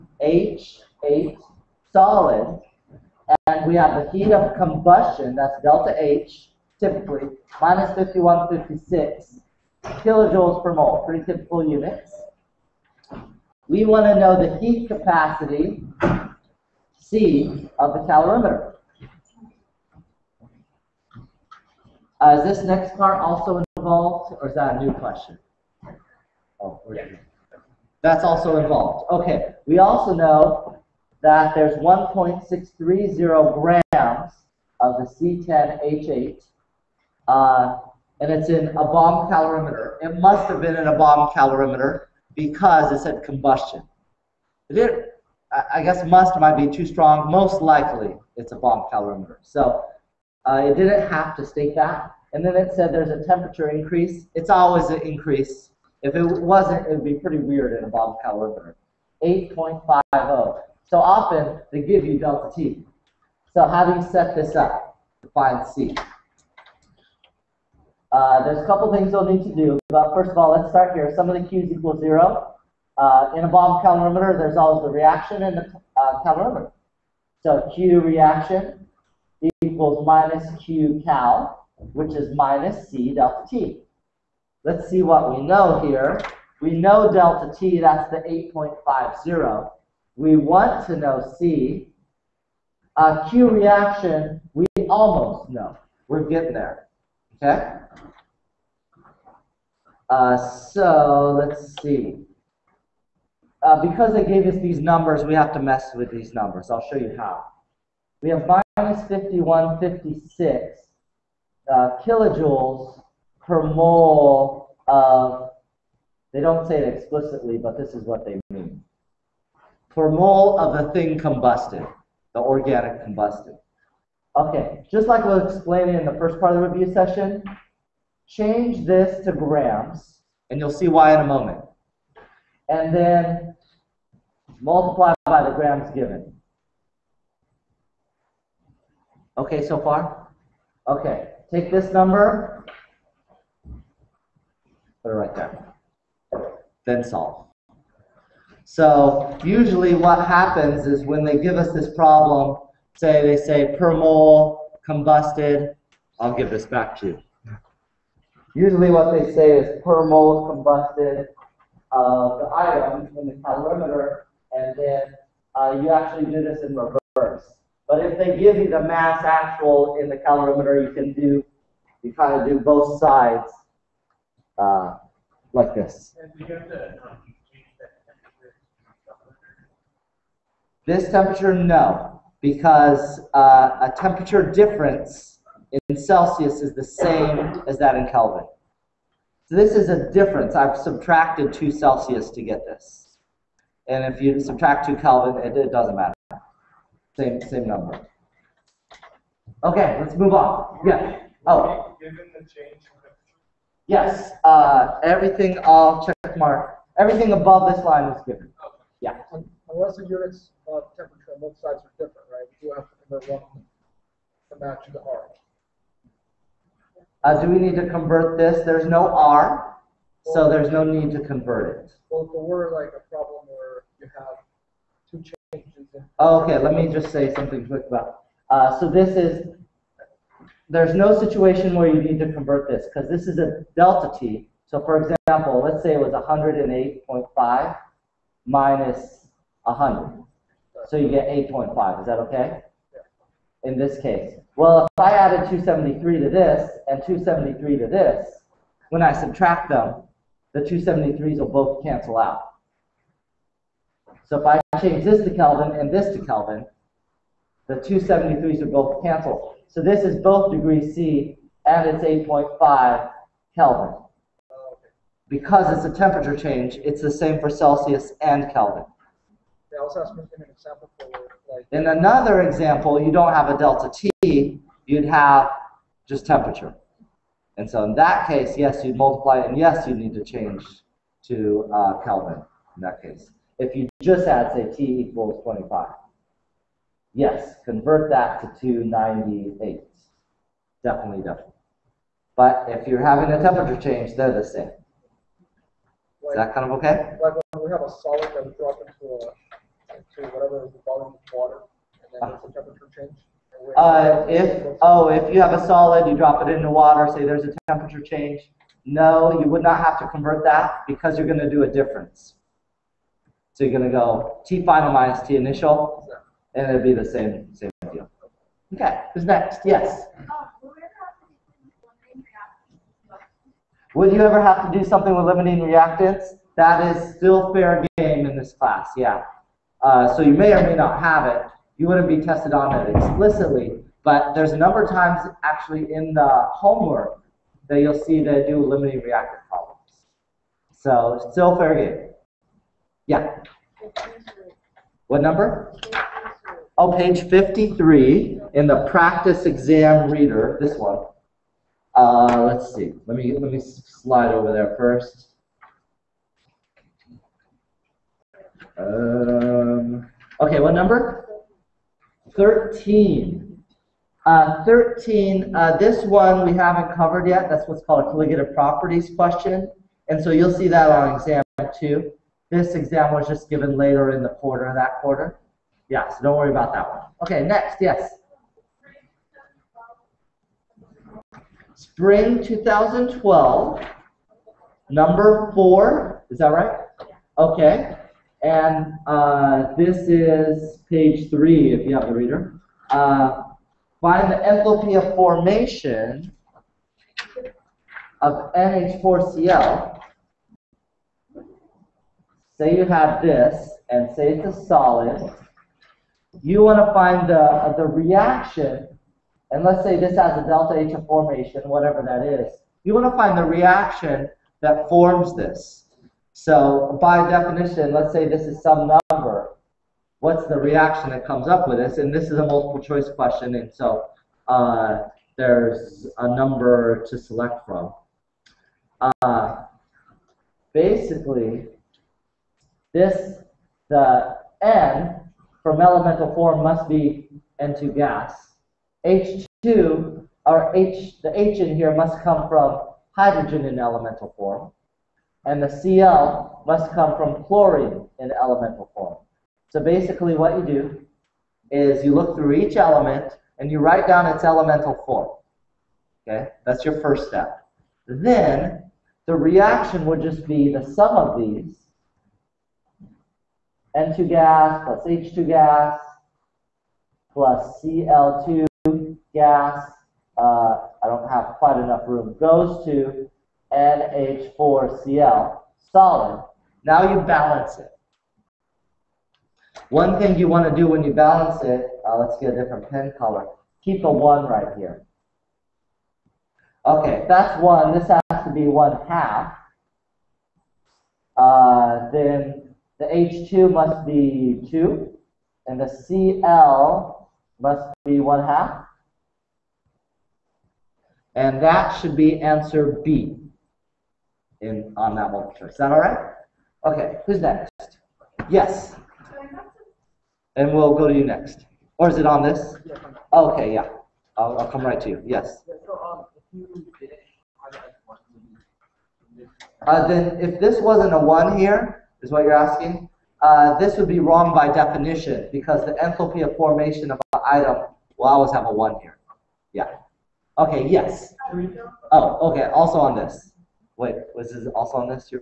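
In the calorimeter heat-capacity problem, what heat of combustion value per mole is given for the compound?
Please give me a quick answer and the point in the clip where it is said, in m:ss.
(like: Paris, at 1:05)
-5156 kJ/mol, at 0:07.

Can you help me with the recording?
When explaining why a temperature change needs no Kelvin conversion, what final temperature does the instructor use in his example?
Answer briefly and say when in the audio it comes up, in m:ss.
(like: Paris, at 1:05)
108.5, at 3:56.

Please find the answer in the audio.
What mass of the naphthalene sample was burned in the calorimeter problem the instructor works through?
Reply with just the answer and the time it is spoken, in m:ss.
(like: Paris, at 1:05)
1.630 grams, at 0:31.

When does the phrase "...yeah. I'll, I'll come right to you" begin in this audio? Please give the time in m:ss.
8:33.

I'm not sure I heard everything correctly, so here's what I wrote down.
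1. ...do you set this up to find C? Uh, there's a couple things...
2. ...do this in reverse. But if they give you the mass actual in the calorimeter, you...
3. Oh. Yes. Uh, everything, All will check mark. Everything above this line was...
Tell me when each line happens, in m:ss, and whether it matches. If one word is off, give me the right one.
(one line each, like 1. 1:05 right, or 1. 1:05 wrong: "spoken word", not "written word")
1. 1:03 right
2. 2:46 right
3. 3:21 right.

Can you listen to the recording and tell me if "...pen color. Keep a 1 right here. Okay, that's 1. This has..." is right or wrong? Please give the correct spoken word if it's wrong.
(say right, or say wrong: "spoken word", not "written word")
right.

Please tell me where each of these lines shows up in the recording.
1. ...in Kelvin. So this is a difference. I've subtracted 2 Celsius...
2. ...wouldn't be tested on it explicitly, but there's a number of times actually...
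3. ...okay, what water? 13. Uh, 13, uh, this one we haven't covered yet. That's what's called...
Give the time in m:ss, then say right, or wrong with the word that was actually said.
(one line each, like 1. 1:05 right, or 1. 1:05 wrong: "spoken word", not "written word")
1. 3:07 right
2. 5:31 right
3. 6:00 wrong: "number", not "water".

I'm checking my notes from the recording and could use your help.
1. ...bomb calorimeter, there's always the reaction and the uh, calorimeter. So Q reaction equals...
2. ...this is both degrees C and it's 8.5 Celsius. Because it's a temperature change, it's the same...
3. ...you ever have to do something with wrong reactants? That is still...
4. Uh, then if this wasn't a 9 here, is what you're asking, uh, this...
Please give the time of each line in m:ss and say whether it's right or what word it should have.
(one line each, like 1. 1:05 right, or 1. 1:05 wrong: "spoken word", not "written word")
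1. 1:13 right
2. 4:19 wrong: "Kelvin", not "Celsius"
3. 5:24 wrong: "limiting", not "wrong"
4. 8:39 wrong: "1", not "9".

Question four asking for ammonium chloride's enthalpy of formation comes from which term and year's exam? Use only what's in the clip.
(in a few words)
Spring 2012.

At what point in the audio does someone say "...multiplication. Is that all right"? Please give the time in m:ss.
8:25.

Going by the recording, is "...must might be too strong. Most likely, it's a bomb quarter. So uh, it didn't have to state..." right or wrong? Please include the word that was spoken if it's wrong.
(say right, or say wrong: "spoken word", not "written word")
wrong: "calorimeter", not "quarter".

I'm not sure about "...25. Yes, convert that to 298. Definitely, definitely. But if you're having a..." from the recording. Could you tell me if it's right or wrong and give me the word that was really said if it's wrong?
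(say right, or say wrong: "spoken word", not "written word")
right.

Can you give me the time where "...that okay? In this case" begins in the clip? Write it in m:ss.
4:02.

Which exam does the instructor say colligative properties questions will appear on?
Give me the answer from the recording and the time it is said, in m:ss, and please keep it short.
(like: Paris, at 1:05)
Exam 2, at 6:11.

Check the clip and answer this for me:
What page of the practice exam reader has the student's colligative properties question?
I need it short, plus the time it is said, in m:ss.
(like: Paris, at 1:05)
Page 53, at 5:46.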